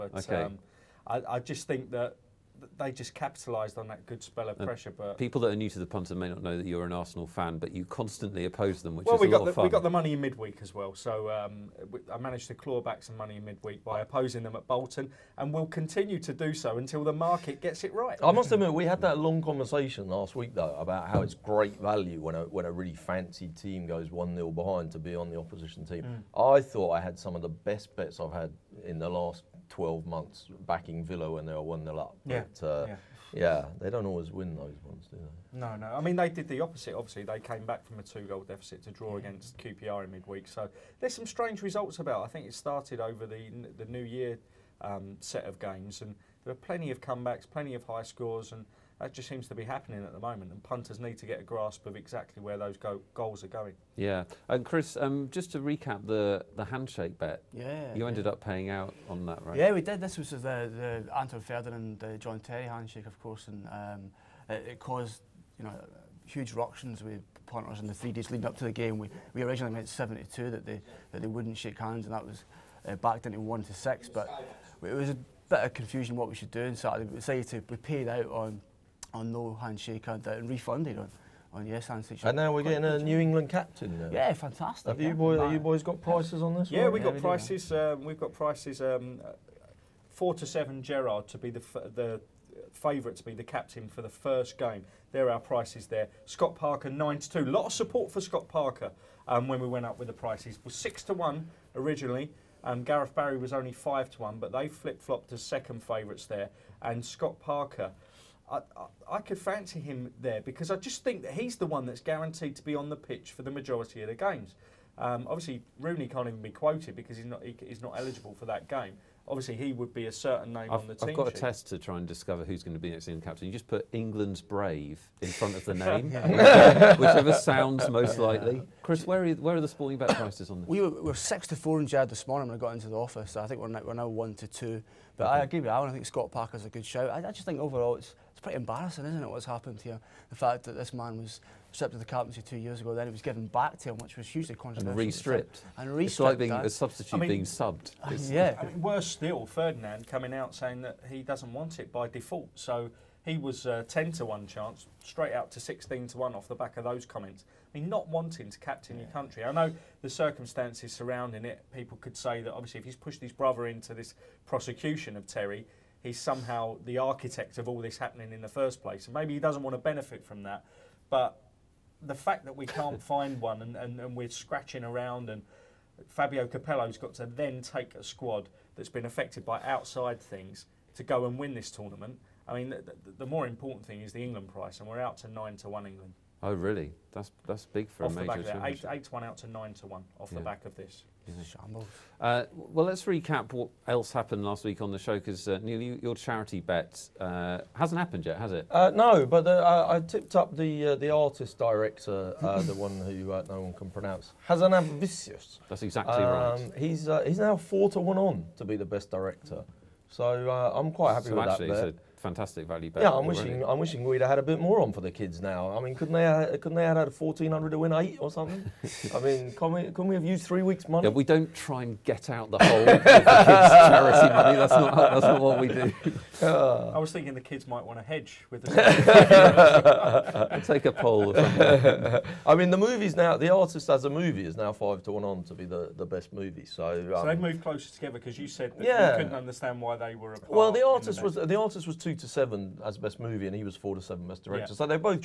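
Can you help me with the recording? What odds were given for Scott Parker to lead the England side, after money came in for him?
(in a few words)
9 to 2.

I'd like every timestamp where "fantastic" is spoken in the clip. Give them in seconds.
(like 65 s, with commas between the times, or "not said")
84 s, 212 s.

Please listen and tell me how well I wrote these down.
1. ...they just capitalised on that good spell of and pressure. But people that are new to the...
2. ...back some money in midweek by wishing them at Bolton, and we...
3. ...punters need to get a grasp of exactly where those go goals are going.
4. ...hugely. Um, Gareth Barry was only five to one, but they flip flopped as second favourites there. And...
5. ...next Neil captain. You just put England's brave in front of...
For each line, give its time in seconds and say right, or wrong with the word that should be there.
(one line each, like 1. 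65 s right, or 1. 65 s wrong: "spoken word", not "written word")
1. 2 s right
2. 12 s wrong: "opposing", not "wishing"
3. 50 s right
4. 101 s wrong: "originally", not "hugely"
5. 122 s wrong: "England", not "Neil".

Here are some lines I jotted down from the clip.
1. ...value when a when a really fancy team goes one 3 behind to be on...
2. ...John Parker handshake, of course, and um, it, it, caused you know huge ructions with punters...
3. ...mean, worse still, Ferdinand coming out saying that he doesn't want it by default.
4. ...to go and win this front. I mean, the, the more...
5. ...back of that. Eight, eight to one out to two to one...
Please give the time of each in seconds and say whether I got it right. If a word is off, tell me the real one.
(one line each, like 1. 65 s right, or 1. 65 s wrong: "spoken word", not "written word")
1. 21 s wrong: "0", not "3"
2. 62 s wrong: "Terry", not "Parker"
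3. 148 s right
4. 180 s wrong: "tournament", not "front"
5. 188 s wrong: "nine", not "two".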